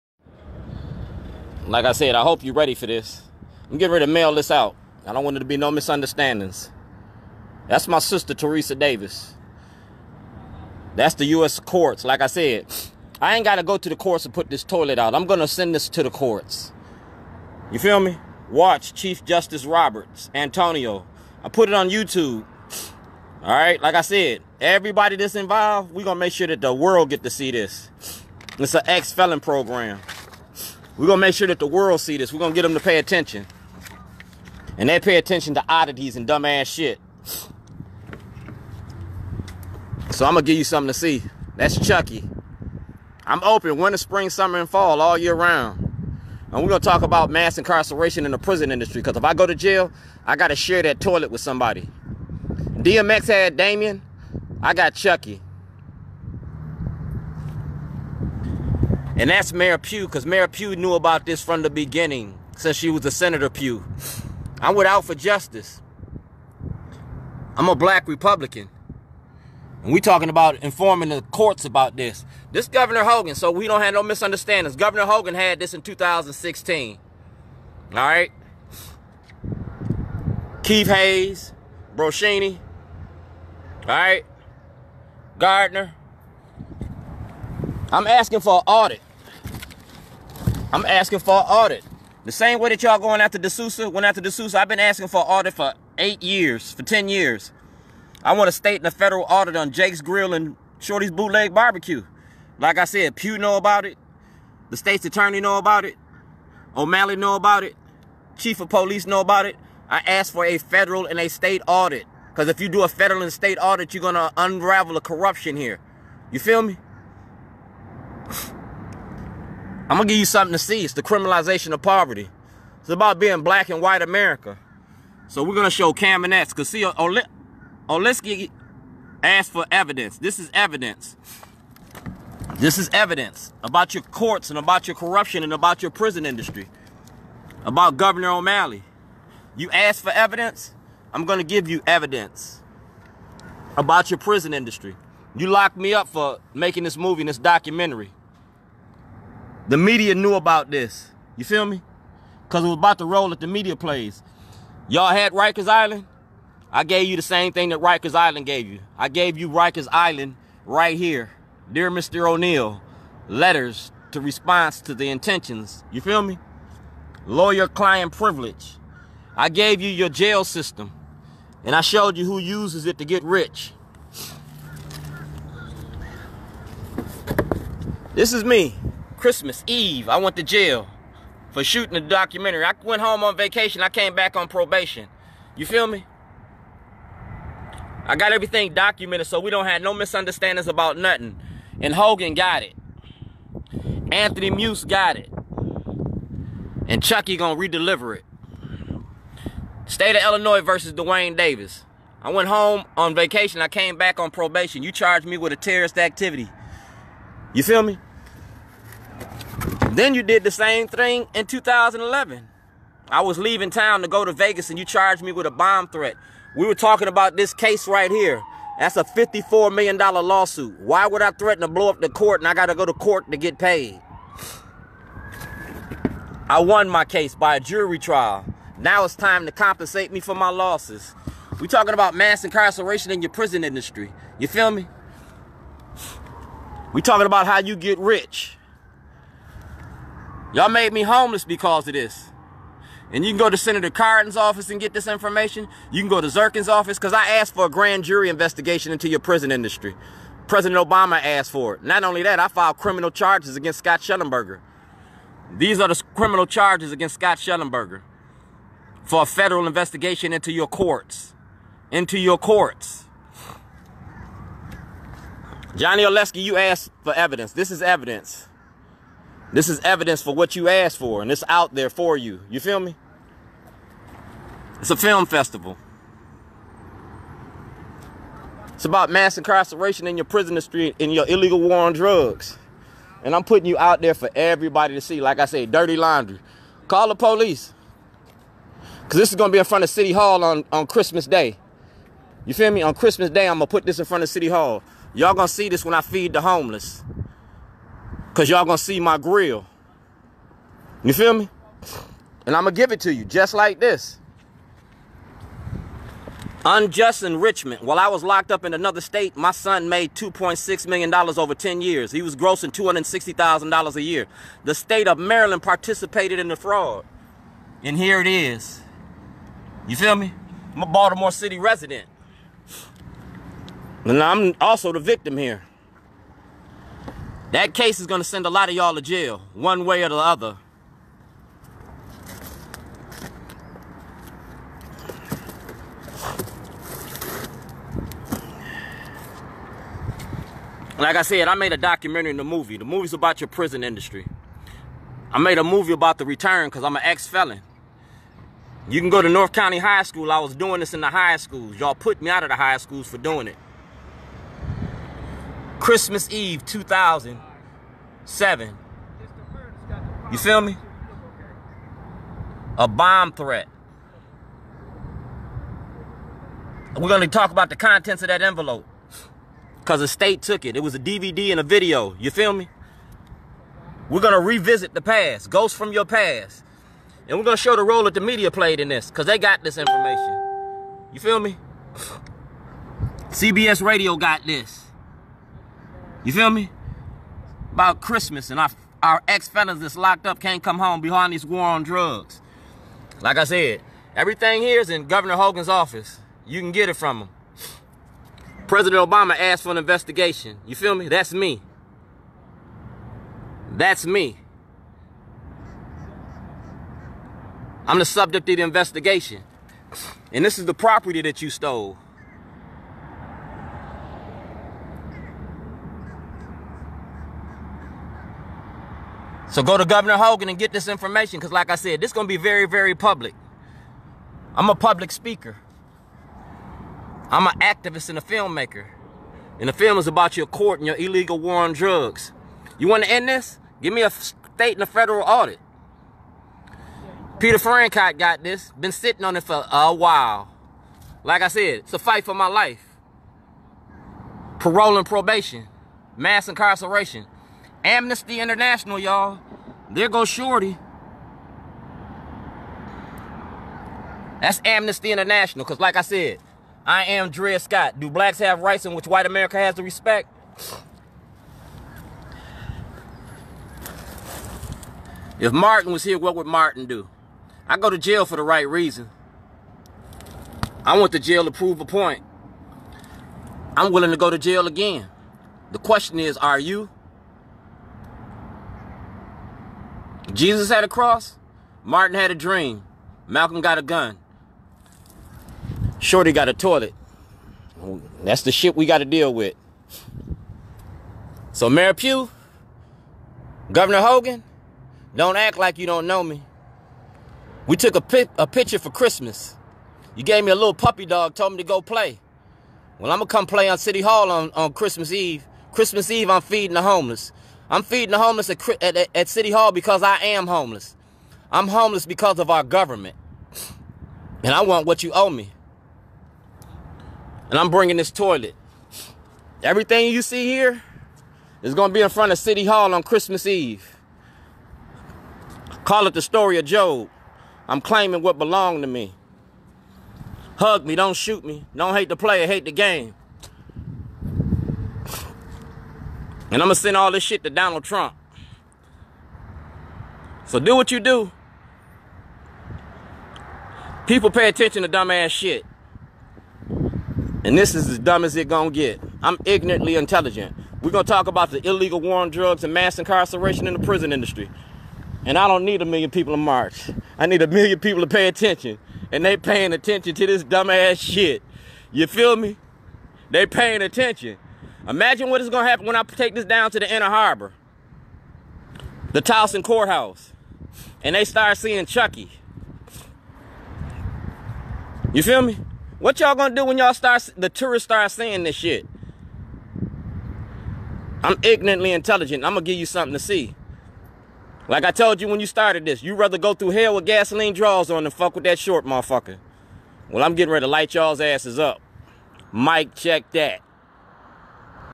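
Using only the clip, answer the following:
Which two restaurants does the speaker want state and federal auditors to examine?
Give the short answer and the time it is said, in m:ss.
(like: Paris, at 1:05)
Jake's Grill and Shorty's Bootleg Barbecue, at 1:39.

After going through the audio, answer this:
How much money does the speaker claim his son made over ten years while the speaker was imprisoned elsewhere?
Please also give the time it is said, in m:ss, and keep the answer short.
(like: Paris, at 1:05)
$2.6 million, at 5:10.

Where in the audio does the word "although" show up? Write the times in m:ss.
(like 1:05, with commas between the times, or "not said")
not said.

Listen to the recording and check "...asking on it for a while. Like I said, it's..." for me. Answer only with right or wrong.
wrong.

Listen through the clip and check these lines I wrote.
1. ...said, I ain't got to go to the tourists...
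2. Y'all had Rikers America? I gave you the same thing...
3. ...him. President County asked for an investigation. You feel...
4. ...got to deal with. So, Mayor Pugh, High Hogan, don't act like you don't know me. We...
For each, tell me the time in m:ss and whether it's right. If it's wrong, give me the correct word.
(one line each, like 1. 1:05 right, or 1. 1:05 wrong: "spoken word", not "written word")
1. 0:12 wrong: "courts", not "tourists"
2. 2:34 wrong: "Island", not "America"
3. 6:37 wrong: "Obama", not "County"
4. 8:08 wrong: "Governor", not "High".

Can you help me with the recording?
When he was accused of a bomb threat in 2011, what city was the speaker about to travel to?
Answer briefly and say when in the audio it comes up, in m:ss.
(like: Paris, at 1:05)
Vegas, at 3:34.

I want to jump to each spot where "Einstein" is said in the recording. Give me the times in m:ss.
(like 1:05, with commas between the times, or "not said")
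not said.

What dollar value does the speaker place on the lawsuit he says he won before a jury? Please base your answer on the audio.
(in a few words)
$54 million.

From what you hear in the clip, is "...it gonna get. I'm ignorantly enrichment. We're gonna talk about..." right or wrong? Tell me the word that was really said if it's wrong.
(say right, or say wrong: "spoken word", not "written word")
wrong: "intelligent", not "enrichment".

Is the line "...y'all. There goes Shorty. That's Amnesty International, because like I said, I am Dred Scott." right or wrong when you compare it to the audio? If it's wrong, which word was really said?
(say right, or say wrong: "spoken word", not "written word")
right.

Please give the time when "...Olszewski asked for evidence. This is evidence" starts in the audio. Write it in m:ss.
2:07.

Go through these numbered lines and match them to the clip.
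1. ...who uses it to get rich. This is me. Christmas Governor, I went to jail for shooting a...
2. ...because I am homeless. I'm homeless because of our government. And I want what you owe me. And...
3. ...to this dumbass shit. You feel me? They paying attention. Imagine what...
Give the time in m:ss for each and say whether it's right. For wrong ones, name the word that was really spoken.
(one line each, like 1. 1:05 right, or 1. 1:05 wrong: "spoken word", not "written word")
1. 2:52 wrong: "Eve", not "Governor"
2. 8:29 right
3. 9:20 right.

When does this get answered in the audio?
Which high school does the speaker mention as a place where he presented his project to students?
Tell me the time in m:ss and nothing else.
5:49.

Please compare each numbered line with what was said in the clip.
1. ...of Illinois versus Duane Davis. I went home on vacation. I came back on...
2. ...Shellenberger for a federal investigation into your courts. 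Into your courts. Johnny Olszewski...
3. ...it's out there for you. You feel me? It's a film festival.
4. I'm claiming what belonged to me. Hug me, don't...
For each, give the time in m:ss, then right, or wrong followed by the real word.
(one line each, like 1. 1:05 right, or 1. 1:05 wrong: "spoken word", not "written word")
1. 3:20 right
2. 4:17 right
3. 4:31 right
4. 8:47 right.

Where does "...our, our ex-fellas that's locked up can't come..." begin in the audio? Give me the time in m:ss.
6:28.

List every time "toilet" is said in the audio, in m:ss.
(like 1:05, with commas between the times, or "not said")
0:14, 0:50, 8:06, 8:38.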